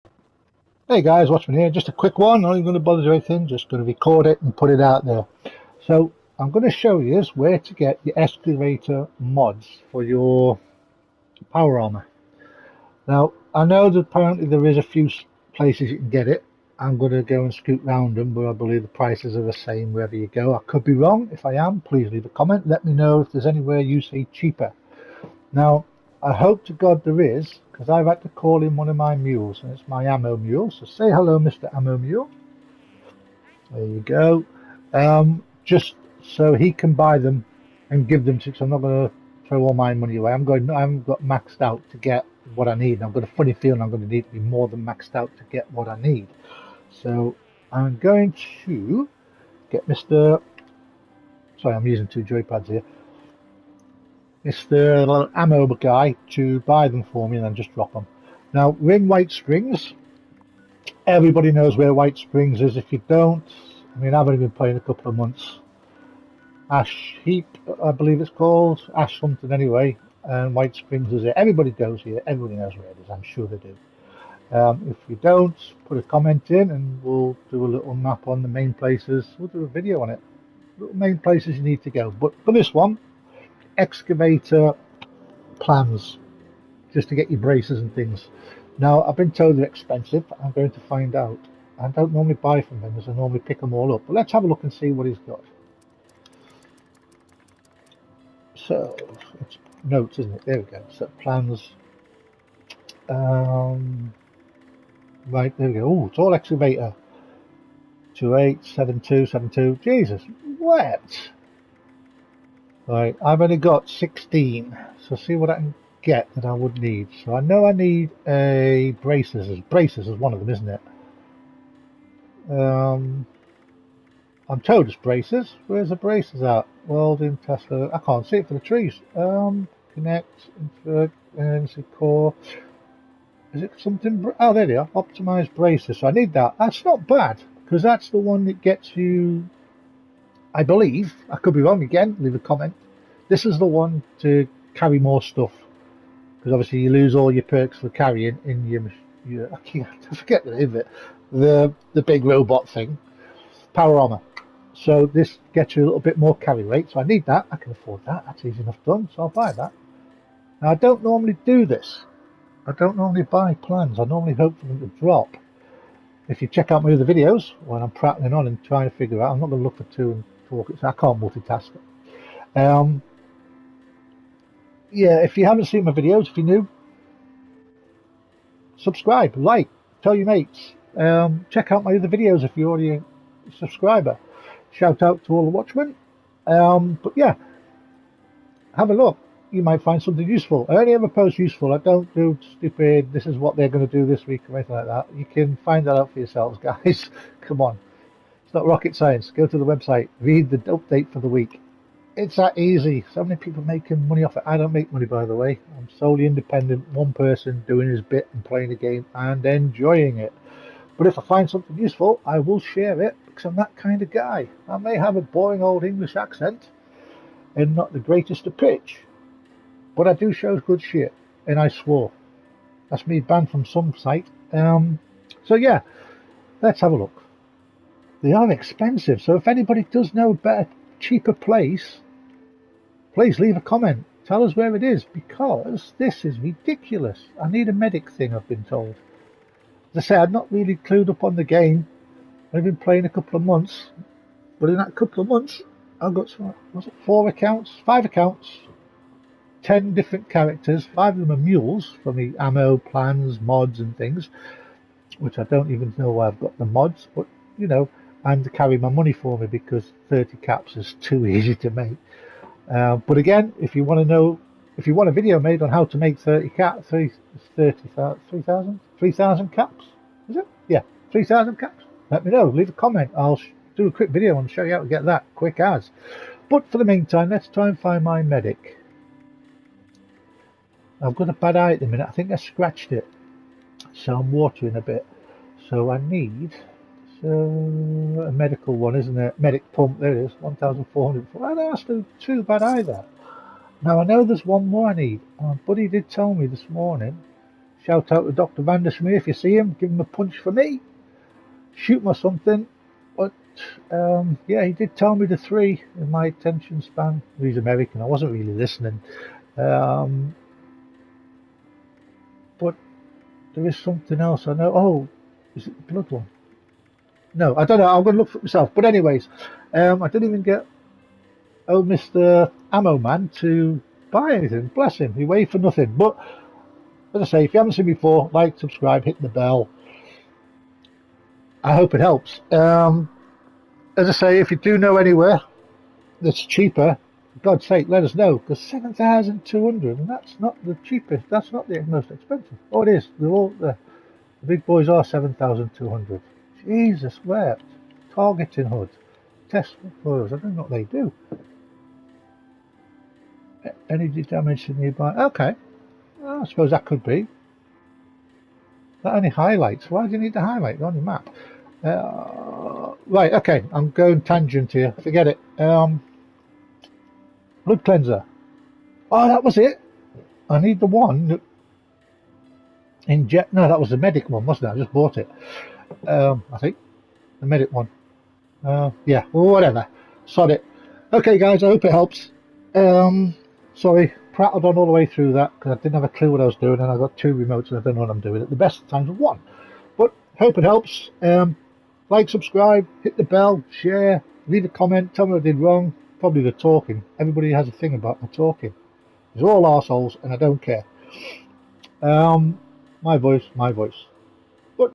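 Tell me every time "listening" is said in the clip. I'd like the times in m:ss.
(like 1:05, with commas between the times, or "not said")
5:08.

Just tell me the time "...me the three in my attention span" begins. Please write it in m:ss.
5:05.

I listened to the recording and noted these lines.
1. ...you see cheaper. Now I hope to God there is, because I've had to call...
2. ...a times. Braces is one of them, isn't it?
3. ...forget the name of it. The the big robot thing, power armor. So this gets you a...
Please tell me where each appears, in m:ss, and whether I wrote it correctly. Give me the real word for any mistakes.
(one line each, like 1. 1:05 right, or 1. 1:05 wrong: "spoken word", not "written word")
1. 0:23 right
2. 1:58 wrong: "braces", not "times"
3. 2:30 right.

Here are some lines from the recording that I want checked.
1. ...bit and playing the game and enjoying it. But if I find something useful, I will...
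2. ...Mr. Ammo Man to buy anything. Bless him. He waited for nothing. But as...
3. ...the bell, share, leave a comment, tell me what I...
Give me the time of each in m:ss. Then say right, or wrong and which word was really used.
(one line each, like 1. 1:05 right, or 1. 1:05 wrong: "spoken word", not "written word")
1. 3:28 right
2. 5:21 right
3. 6:33 right.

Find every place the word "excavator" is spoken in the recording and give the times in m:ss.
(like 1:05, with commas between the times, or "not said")
0:08, 1:23, 1:46.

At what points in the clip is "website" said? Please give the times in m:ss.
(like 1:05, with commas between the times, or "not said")
3:19.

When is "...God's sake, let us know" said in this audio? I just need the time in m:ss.
5:37.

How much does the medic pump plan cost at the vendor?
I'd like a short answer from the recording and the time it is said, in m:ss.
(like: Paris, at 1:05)
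1,400, at 4:50.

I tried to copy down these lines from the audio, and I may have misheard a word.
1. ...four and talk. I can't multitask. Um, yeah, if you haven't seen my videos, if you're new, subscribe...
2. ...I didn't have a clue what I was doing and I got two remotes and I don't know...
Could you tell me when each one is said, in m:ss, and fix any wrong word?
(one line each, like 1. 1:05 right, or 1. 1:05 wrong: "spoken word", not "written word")
1. 2:49 wrong: "two", not "four"
2. 6:25 right.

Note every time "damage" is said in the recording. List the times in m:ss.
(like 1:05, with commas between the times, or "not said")
5:54.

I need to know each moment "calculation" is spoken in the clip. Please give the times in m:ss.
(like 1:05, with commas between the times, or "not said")
not said.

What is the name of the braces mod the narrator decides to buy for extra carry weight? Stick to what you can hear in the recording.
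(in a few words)
Optimized braces.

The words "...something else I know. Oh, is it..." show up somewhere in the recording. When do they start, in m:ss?
5:13.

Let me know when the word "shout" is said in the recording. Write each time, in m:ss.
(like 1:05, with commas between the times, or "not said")
3:04, 4:57.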